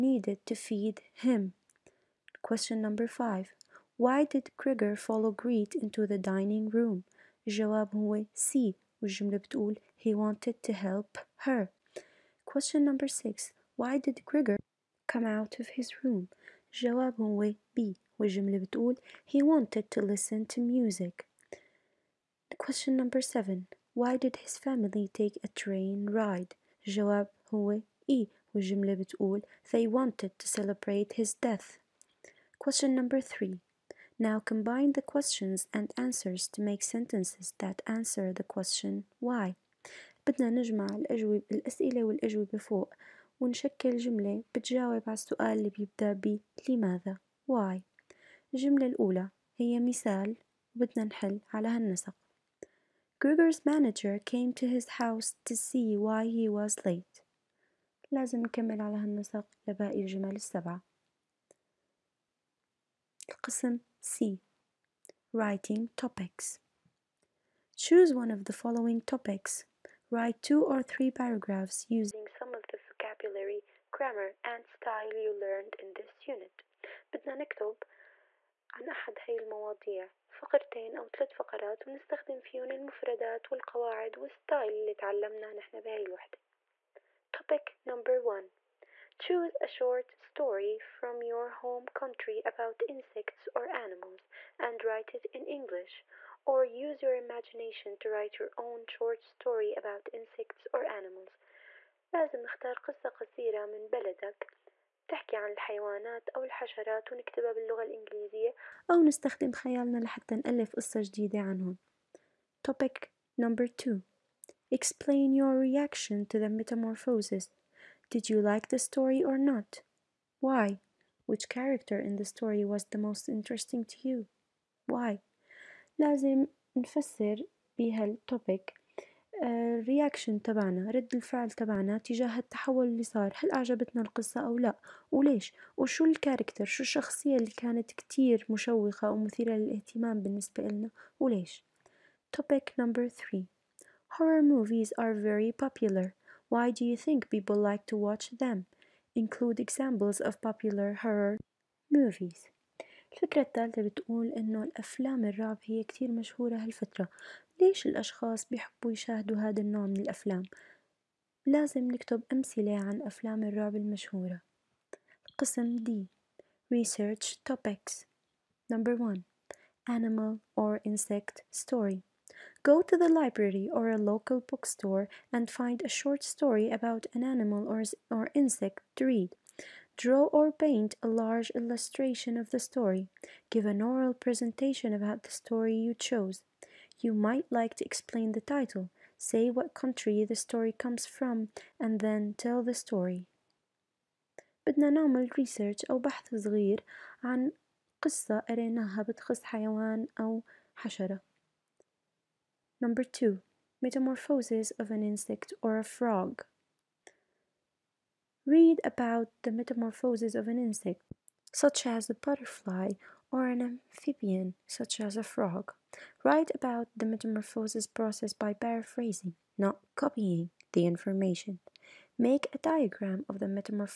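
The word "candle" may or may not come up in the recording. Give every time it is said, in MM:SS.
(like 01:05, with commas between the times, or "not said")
not said.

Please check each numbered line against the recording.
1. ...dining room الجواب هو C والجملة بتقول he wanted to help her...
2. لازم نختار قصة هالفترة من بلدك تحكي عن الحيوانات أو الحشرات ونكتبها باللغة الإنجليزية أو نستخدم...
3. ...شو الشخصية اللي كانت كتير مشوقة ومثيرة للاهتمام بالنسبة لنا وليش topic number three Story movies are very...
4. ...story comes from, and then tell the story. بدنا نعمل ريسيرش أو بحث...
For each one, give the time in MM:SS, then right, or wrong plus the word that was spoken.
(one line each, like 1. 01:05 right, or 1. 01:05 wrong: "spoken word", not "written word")
1. 00:06 right
2. 01:42 wrong: "قصيرة", not "هالفترة"
3. 02:16 wrong: "Horror", not "Story"
4. 03:10 right.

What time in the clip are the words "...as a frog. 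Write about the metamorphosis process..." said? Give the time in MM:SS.
03:34.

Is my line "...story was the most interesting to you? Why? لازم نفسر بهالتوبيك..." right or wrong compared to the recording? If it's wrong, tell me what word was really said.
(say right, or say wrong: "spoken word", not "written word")
right.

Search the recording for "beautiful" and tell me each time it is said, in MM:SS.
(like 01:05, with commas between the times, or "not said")
not said.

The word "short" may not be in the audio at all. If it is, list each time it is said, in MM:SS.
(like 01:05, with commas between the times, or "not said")
01:29, 01:38, 02:55.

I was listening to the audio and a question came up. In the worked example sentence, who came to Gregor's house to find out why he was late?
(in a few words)
Gregor's manager.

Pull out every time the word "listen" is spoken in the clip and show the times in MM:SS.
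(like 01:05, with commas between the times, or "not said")
00:20.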